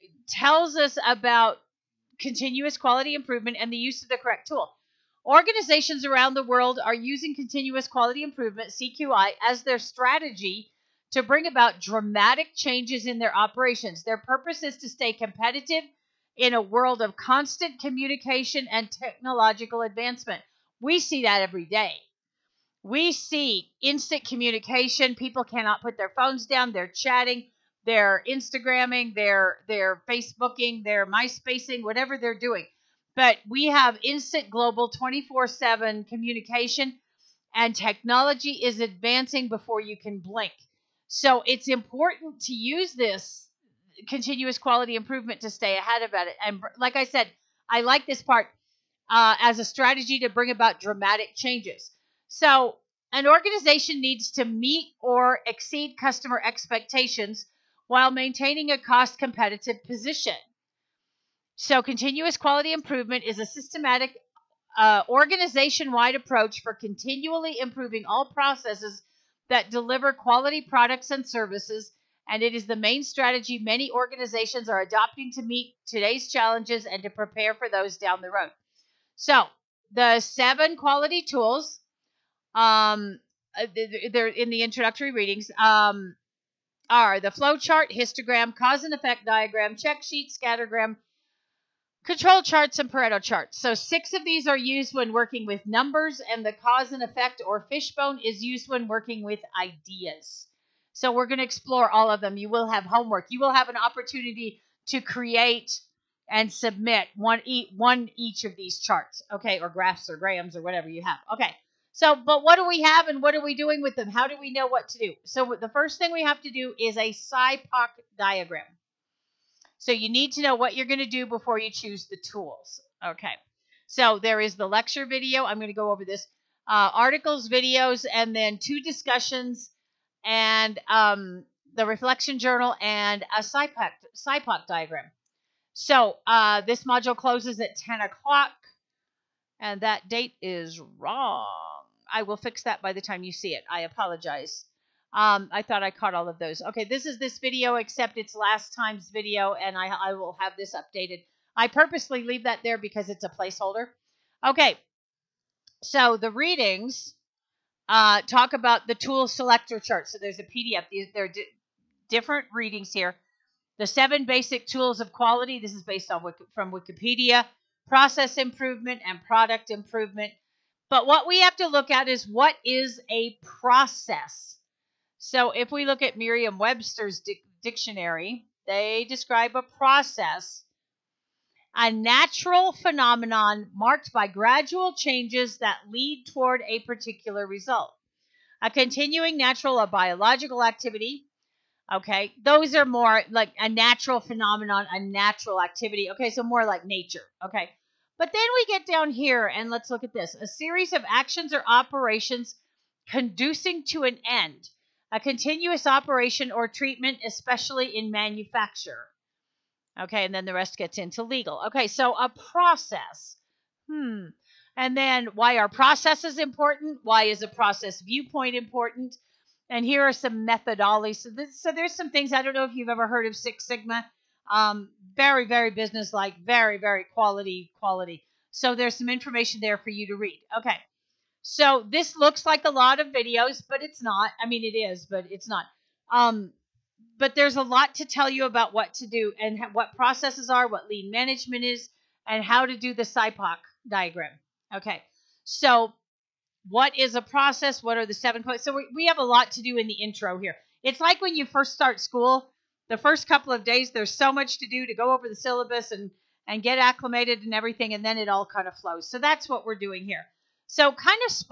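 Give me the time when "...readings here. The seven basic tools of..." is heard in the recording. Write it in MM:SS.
02:42.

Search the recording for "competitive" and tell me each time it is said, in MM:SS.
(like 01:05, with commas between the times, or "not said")
00:15, 00:59.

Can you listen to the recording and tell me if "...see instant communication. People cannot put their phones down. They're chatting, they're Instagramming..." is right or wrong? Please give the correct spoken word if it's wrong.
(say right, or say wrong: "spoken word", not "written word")
right.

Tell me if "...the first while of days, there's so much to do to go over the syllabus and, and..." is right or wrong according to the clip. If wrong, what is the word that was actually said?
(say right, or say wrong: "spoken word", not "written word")
wrong: "couple", not "while".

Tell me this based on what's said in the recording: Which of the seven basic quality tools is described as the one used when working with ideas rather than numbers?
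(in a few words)
cause and effect diagram.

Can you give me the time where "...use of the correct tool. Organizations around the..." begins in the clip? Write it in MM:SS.
00:03.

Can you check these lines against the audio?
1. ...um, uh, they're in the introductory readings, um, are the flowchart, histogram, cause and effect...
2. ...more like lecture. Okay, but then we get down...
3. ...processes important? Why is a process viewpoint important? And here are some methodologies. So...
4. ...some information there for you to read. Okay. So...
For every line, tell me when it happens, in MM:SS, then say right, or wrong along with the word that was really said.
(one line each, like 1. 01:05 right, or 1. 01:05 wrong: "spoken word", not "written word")
1. 01:22 right
2. 03:16 wrong: "nature", not "lecture"
3. 03:35 right
4. 03:48 right.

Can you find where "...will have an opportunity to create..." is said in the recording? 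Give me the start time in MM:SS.
01:43.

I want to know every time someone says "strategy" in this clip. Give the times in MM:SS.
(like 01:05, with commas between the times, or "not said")
00:09, 00:49, 01:13.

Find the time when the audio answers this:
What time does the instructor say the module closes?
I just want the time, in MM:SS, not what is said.
02:17.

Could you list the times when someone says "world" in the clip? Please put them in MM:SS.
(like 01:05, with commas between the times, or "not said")
00:06, 00:16.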